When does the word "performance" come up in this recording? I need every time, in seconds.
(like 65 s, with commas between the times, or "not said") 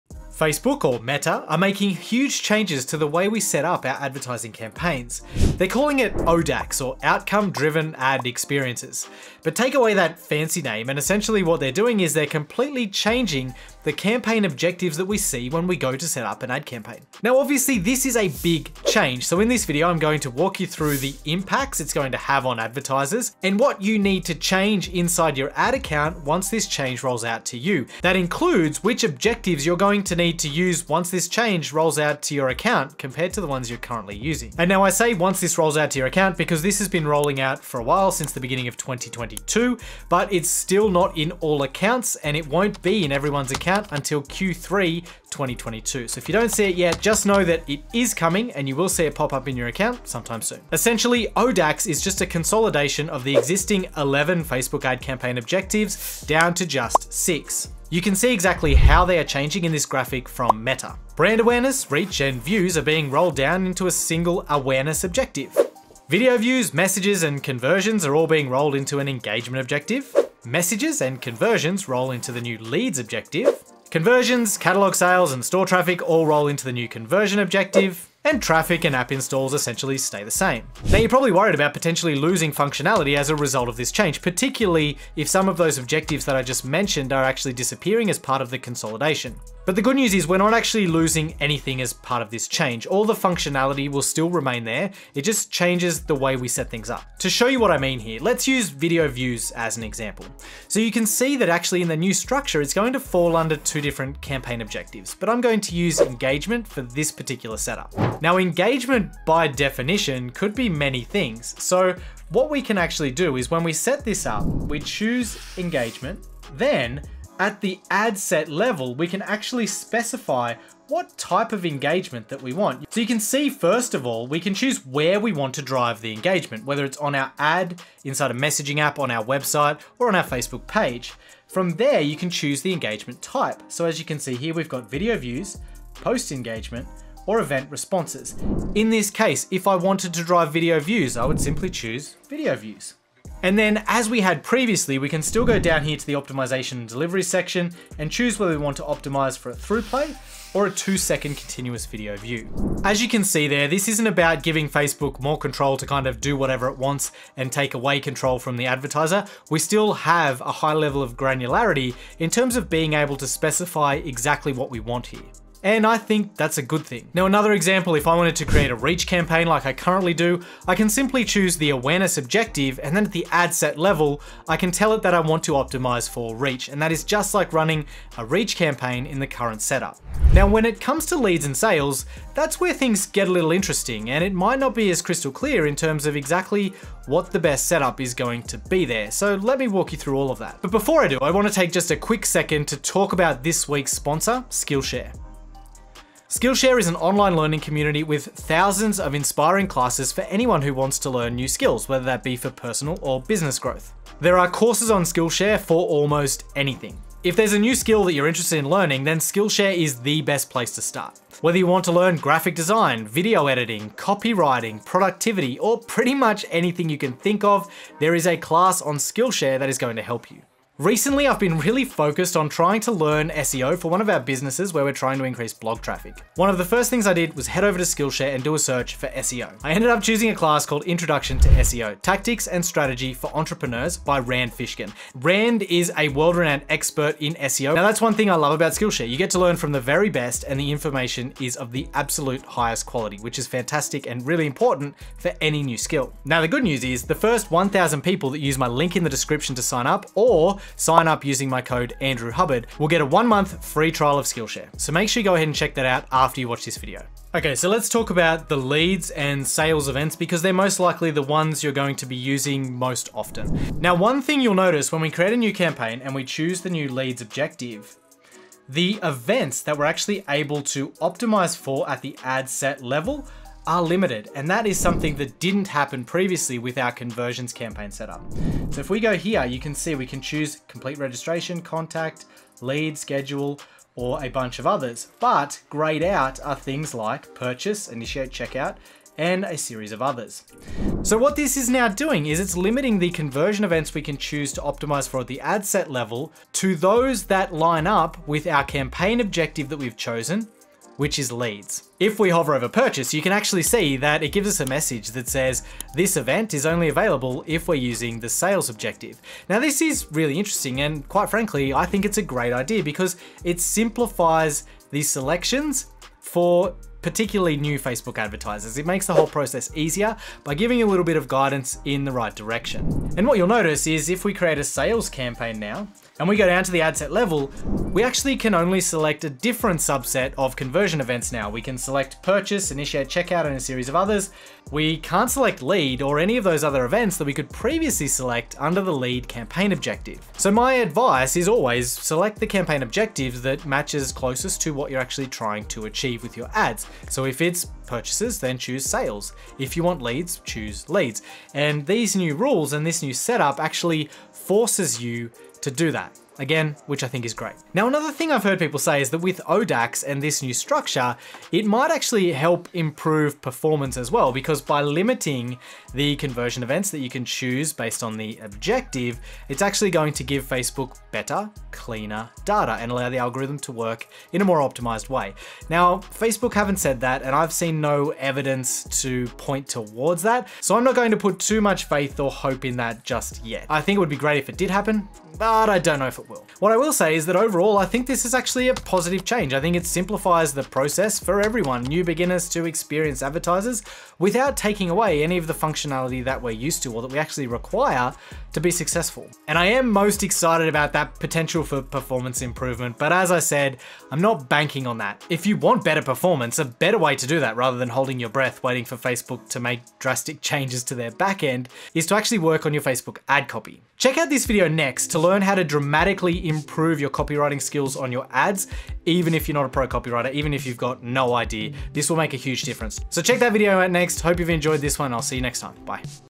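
363 s, 401 s, 406 s.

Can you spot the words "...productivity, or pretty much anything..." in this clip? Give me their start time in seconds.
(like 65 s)
214 s.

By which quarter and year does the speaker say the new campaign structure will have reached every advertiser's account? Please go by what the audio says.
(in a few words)
Q3 2022.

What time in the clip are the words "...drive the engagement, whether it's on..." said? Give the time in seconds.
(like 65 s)
125 s.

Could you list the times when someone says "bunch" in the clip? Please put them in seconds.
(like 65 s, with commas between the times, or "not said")
284 s.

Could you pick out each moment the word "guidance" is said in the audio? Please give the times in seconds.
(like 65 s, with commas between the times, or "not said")
321 s.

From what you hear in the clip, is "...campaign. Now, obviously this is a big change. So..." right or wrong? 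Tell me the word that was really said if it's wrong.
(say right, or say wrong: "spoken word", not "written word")
right.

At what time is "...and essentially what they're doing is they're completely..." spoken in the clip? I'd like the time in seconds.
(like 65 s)
10 s.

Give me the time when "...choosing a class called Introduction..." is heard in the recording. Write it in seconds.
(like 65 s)
230 s.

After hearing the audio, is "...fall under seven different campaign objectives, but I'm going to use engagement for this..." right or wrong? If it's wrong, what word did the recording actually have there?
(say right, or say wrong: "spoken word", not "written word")
wrong: "two", not "seven".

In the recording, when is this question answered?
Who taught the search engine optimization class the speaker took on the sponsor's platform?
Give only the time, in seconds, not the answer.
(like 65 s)
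234 s.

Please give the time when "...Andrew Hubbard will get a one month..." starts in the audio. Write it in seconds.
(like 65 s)
252 s.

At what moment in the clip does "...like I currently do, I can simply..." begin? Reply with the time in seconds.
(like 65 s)
169 s.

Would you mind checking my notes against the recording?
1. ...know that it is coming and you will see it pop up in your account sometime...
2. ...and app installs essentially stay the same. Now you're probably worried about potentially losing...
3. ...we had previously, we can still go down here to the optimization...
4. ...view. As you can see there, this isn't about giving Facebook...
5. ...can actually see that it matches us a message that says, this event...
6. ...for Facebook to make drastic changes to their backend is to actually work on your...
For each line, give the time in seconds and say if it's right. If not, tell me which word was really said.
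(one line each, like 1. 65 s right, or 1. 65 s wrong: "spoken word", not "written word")
1. 47 s right
2. 78 s right
3. 144 s right
4. 152 s right
5. 303 s wrong: "gives", not "matches"
6. 408 s right.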